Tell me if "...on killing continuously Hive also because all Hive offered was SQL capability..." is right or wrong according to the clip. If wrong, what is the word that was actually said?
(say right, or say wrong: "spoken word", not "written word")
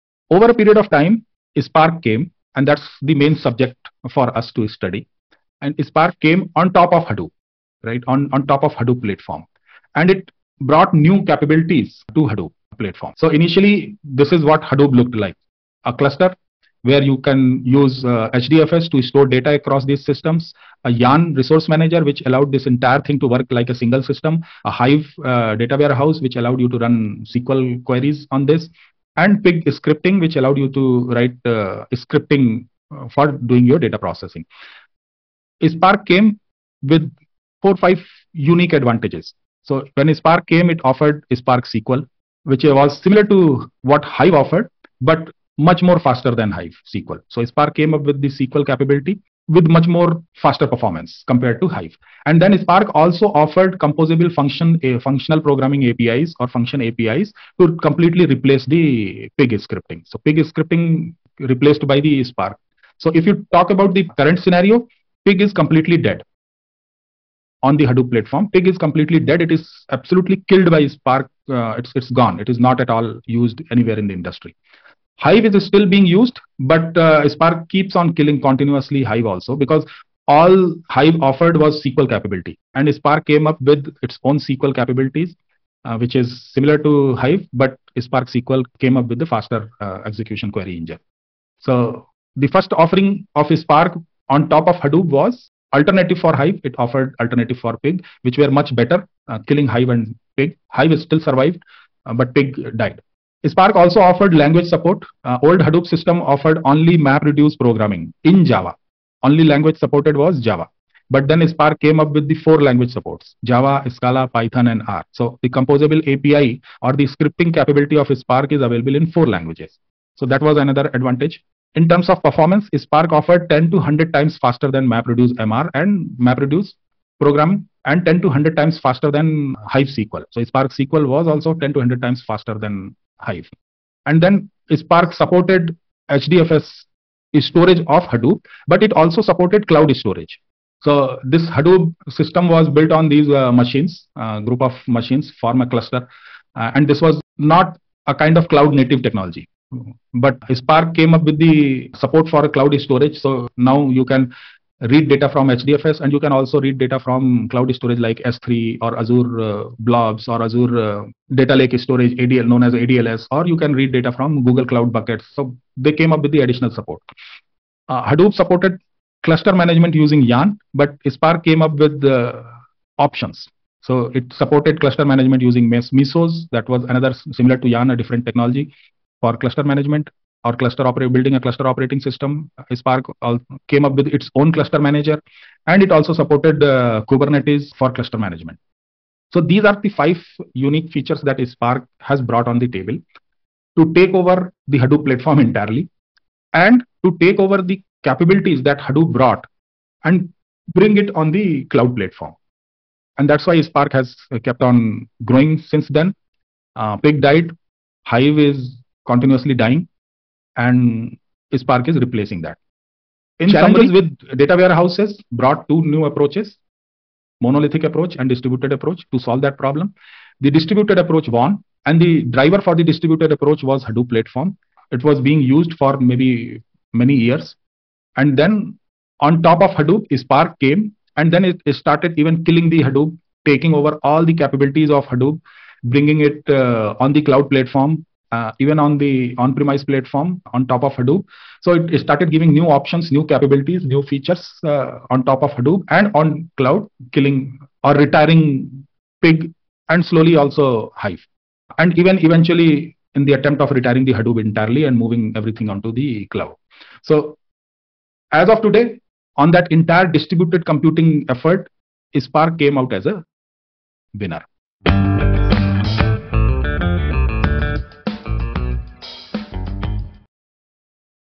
right.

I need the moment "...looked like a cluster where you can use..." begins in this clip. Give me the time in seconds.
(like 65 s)
14 s.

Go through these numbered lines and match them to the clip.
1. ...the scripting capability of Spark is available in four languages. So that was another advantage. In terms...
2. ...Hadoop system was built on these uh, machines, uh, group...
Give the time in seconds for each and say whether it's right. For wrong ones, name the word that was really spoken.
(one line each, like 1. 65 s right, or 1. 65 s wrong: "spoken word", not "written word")
1. 116 s right
2. 141 s right.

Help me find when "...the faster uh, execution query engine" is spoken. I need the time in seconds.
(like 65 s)
89 s.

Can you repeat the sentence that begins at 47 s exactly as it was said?
So Spark came up with the SQL capability with much more faster performance compared to Hive.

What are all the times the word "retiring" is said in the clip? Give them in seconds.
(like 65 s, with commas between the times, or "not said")
247 s, 253 s.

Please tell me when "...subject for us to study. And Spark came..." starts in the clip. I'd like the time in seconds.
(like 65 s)
3 s.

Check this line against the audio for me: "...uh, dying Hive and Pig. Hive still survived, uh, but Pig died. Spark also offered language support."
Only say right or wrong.
wrong.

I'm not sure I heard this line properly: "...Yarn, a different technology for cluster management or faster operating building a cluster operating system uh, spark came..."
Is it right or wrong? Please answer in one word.
wrong.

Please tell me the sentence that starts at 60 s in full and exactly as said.
So Pig scripting replaced by the Spark.